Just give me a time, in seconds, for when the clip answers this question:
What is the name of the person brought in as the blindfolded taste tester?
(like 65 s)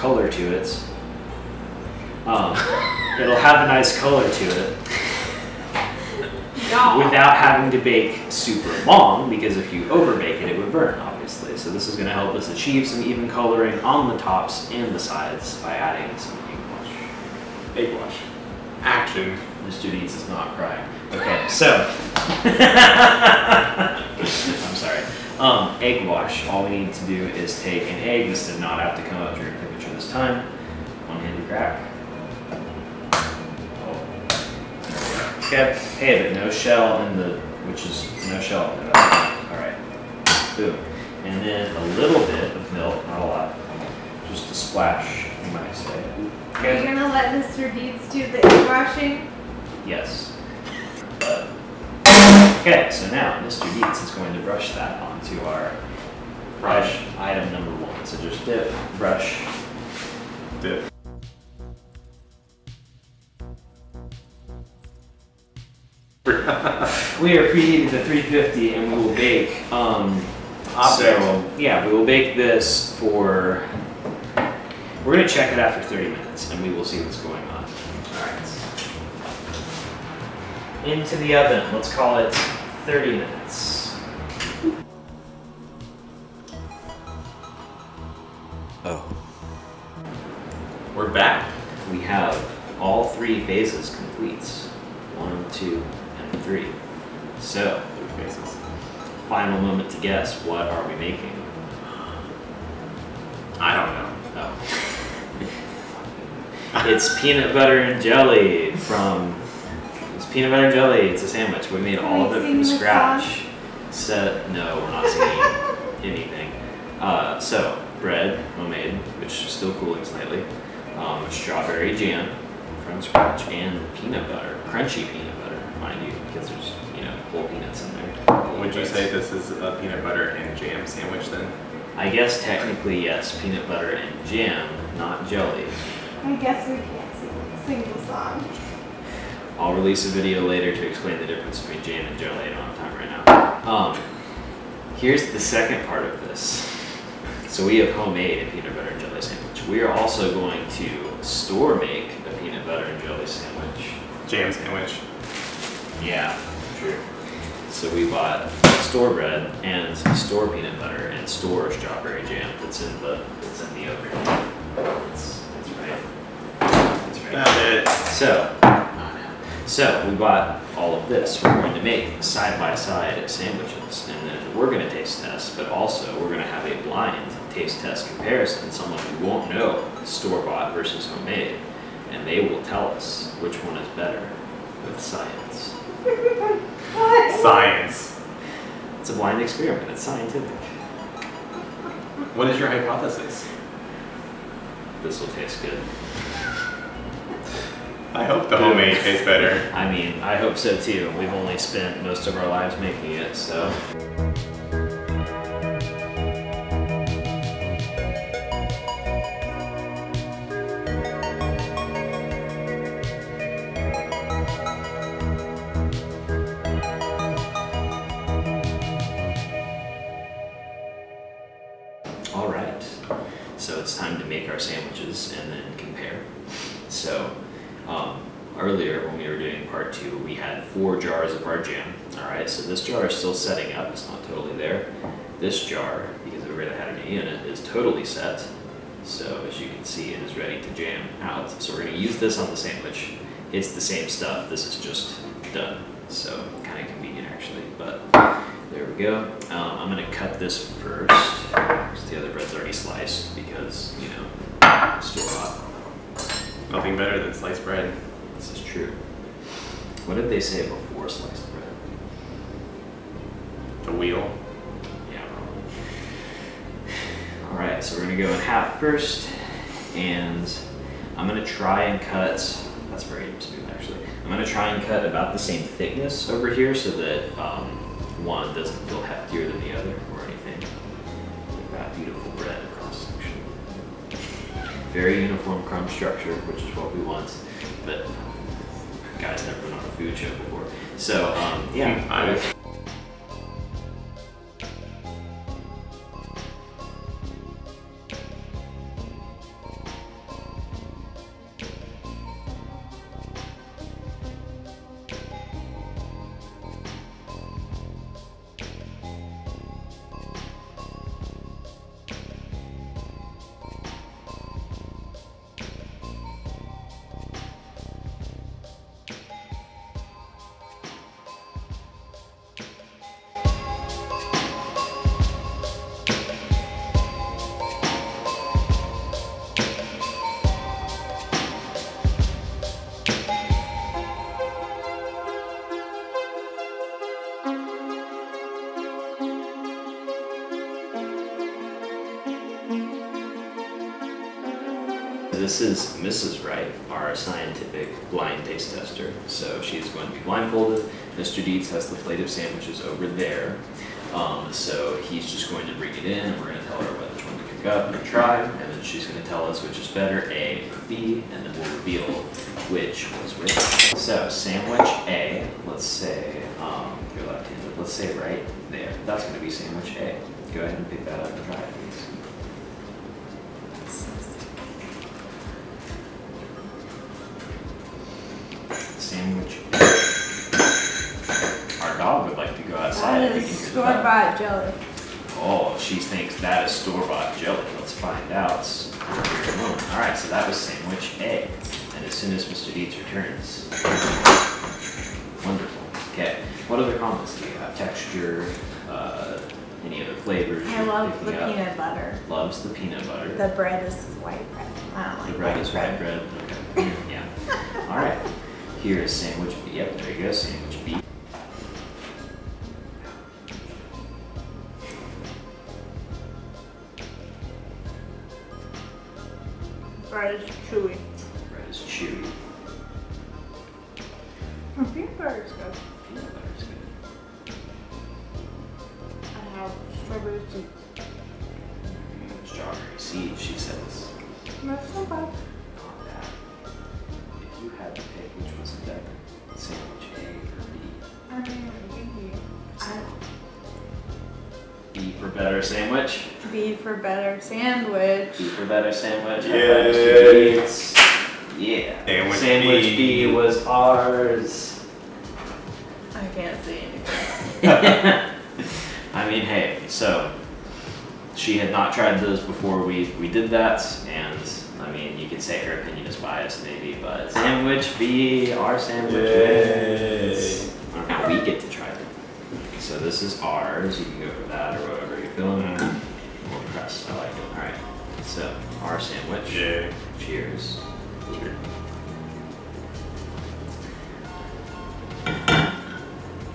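345 s.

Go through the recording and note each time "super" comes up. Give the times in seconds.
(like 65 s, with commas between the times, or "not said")
8 s.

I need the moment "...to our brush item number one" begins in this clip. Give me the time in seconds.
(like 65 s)
55 s.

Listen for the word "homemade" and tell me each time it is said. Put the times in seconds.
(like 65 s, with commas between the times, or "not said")
118 s, 147 s, 181 s, 198 s.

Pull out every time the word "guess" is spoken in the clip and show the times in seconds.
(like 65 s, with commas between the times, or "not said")
99 s, 132 s, 136 s.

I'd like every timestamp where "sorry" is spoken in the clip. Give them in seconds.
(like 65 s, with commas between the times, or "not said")
24 s.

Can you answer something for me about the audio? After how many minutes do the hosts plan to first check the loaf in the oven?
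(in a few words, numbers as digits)
30 minutes.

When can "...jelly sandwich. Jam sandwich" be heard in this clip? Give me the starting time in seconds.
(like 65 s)
153 s.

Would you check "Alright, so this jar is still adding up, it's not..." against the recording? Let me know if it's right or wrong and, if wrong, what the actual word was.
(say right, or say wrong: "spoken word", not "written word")
wrong: "setting", not "adding".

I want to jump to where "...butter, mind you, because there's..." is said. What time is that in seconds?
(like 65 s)
125 s.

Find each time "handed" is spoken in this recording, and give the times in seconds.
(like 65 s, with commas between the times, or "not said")
31 s, 367 s.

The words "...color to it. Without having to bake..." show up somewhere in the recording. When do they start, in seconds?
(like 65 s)
3 s.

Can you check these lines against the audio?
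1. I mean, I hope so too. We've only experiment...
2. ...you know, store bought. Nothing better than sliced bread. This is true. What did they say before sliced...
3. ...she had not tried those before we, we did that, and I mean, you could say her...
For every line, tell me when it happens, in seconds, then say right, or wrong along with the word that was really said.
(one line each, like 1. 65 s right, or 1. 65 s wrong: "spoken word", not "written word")
1. 199 s wrong: "spent", not "experiment"
2. 254 s right
3. 461 s right.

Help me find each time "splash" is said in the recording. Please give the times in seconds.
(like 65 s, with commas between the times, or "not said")
44 s.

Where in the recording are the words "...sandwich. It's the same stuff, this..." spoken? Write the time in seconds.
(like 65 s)
242 s.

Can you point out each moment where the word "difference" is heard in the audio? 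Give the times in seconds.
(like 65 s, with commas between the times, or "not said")
141 s.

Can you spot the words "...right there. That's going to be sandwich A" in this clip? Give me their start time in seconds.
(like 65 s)
368 s.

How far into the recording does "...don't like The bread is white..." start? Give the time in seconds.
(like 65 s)
405 s.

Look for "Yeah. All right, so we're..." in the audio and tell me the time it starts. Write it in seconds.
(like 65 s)
265 s.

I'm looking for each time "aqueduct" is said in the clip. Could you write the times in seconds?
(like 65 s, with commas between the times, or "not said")
not said.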